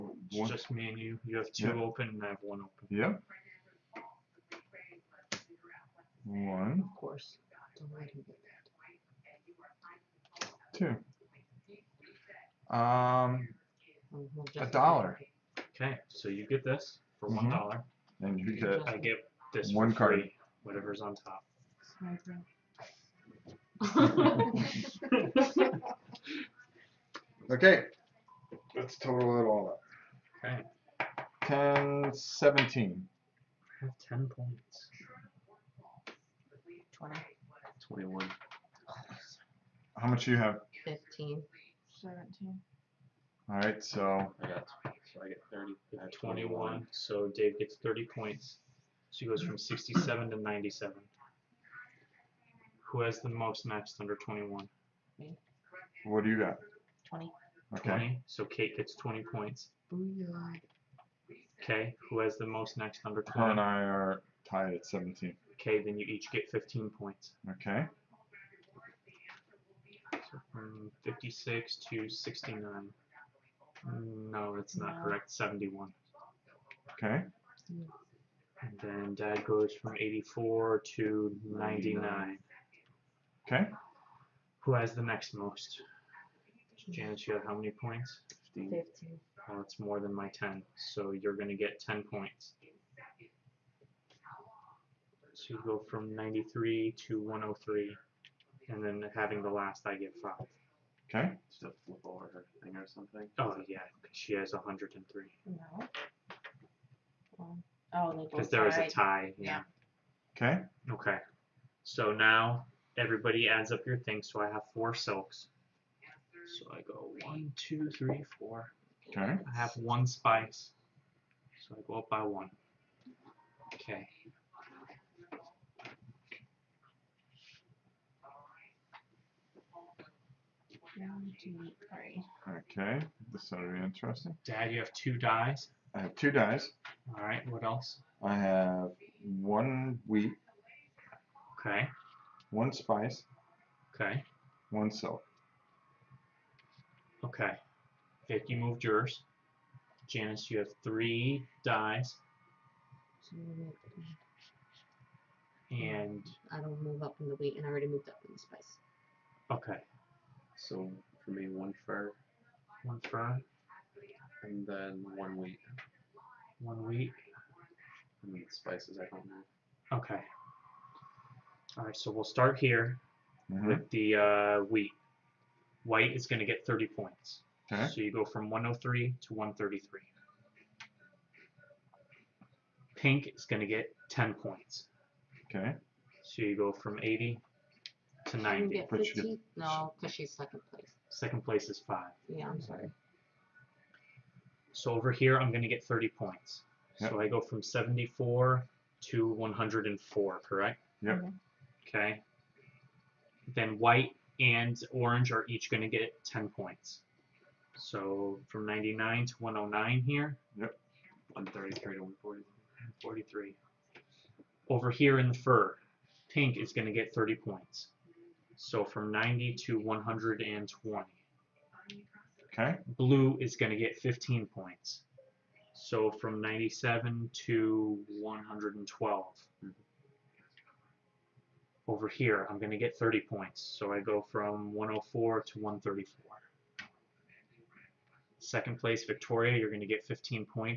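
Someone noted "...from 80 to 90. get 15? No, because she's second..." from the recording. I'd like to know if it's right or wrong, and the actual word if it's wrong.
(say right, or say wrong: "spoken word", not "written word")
right.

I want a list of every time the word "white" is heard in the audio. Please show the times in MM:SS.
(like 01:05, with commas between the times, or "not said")
02:55, 03:23.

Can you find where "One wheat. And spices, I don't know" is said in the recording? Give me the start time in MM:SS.
02:46.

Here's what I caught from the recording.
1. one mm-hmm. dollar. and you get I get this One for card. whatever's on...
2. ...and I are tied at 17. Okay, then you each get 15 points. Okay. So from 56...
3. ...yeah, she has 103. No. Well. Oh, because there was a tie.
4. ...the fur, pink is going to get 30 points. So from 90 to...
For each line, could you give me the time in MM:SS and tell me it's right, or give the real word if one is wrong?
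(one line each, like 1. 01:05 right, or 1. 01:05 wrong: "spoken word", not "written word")
1. 00:17 right
2. 01:03 right
3. 01:43 right
4. 03:35 right.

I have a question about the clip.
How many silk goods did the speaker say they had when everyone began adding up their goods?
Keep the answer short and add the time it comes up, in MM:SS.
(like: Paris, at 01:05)
4, at 01:54.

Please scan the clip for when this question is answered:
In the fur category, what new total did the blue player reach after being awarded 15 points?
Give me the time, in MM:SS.
03:45.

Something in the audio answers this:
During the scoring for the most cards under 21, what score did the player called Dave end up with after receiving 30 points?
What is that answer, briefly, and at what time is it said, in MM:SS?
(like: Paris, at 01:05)
97, at 00:49.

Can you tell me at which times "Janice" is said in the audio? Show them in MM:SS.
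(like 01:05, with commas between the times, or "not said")
01:26, 02:30.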